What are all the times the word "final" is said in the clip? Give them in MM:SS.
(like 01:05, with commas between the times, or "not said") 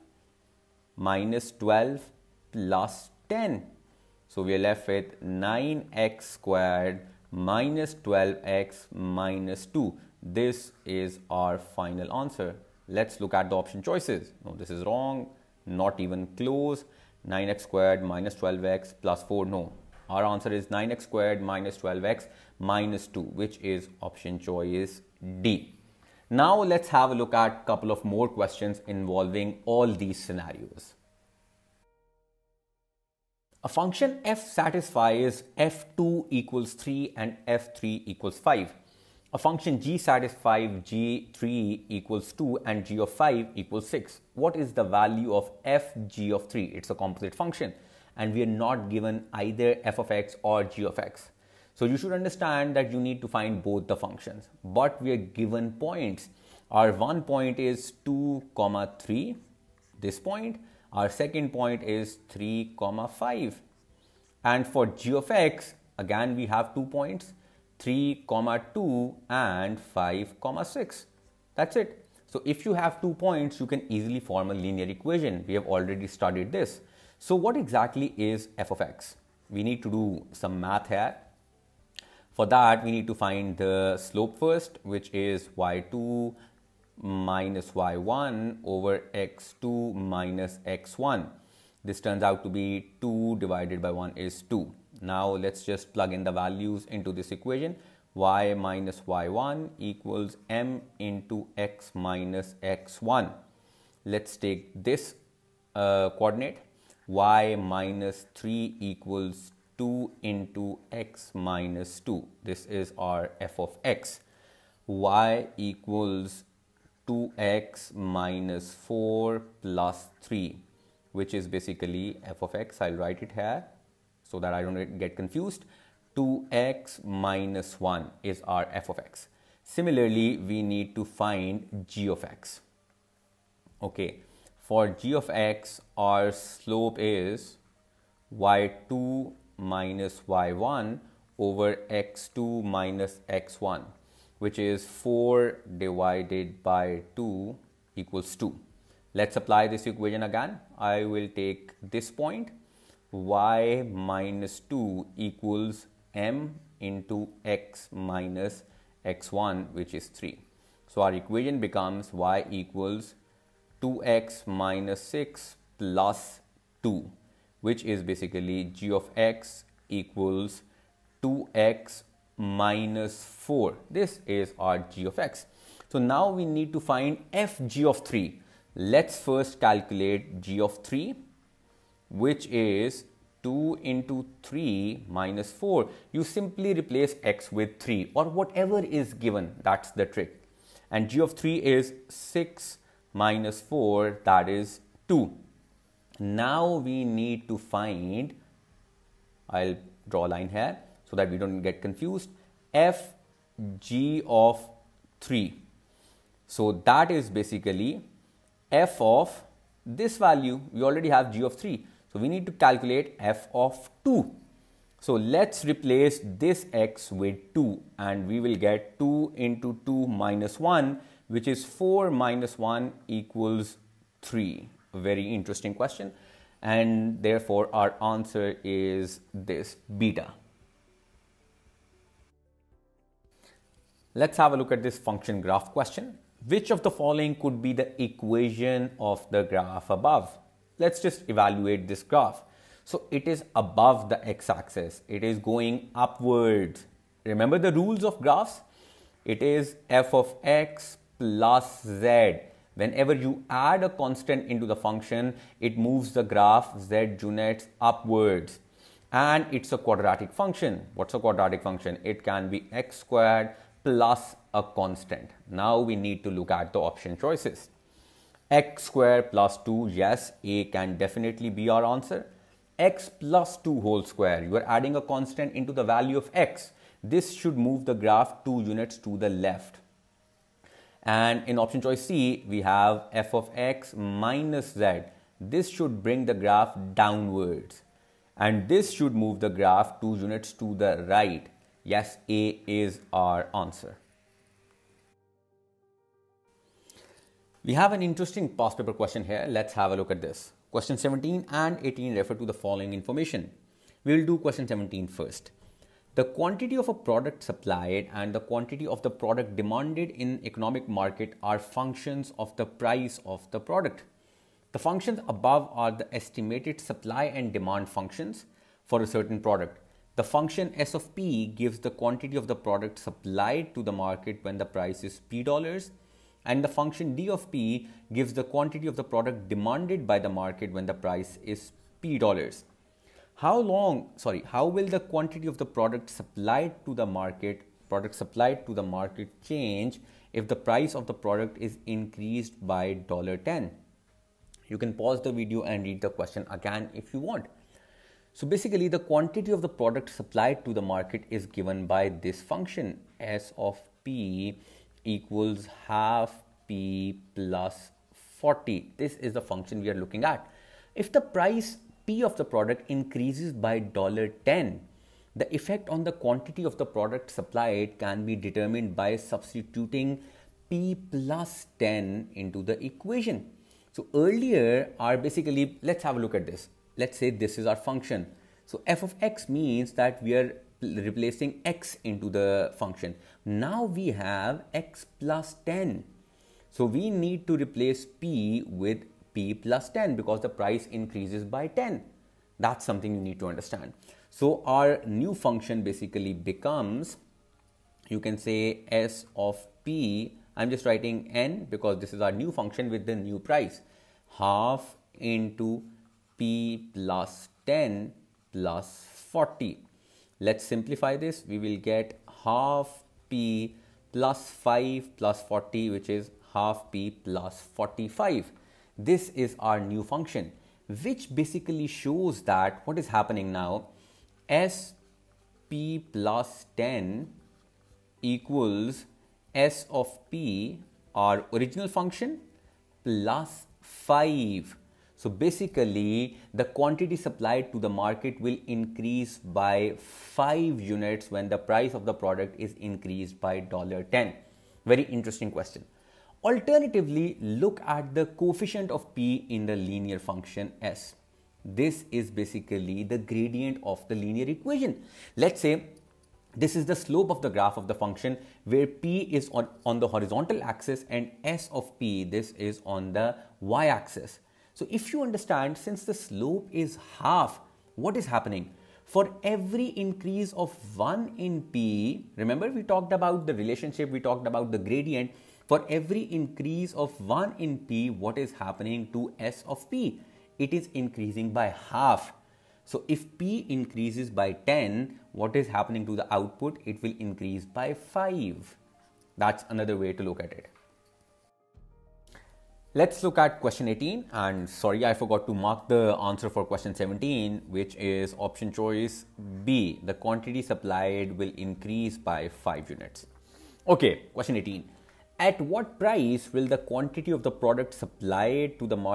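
00:11.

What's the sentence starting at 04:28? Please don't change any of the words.
x square plus 2, yes, a can definitely be our answer.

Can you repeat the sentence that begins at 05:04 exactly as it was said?
We will do question 17 first.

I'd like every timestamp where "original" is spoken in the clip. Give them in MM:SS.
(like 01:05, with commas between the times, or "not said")
07:11.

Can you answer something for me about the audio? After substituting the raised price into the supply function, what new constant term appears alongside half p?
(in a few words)
45.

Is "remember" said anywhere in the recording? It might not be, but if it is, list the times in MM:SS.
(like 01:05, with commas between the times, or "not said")
04:07, 07:52.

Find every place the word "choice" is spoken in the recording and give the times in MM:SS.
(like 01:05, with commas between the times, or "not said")
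00:13, 00:24, 04:27, 04:41, 08:18.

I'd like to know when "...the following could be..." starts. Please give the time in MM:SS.
03:56.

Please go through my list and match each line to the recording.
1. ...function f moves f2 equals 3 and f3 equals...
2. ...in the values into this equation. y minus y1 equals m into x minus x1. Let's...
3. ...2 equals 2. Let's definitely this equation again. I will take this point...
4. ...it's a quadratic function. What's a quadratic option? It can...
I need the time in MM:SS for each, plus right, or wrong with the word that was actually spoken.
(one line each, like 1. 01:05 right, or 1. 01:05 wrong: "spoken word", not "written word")
1. 00:33 wrong: "satisfies", not "moves"
2. 01:36 right
3. 02:27 wrong: "apply", not "definitely"
4. 04:19 wrong: "function", not "option".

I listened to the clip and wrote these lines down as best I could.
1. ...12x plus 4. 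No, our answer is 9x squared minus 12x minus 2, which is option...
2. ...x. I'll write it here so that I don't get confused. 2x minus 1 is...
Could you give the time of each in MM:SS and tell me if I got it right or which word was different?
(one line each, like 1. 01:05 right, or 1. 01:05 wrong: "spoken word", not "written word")
1. 00:18 right
2. 02:02 right.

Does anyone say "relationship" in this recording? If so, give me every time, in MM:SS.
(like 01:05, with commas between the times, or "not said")
07:53.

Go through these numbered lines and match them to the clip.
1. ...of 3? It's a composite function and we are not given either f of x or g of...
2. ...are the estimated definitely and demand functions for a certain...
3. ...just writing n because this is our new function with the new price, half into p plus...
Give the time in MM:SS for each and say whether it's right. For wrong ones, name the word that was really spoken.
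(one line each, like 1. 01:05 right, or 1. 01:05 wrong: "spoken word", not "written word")
1. 00:46 right
2. 05:15 wrong: "supply", not "definitely"
3. 06:40 right.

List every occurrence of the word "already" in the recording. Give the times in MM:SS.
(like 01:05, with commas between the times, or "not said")
01:15, 03:30.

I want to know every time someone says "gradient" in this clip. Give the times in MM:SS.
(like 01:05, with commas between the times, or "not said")
07:33, 07:54.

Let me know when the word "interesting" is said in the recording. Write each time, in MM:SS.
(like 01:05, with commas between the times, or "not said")
03:45, 04:58, 07:25.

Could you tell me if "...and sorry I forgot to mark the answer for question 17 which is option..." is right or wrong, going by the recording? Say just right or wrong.
right.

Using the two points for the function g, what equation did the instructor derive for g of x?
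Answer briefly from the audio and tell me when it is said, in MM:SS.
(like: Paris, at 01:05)
g(x) = 2x - 4, at 02:48.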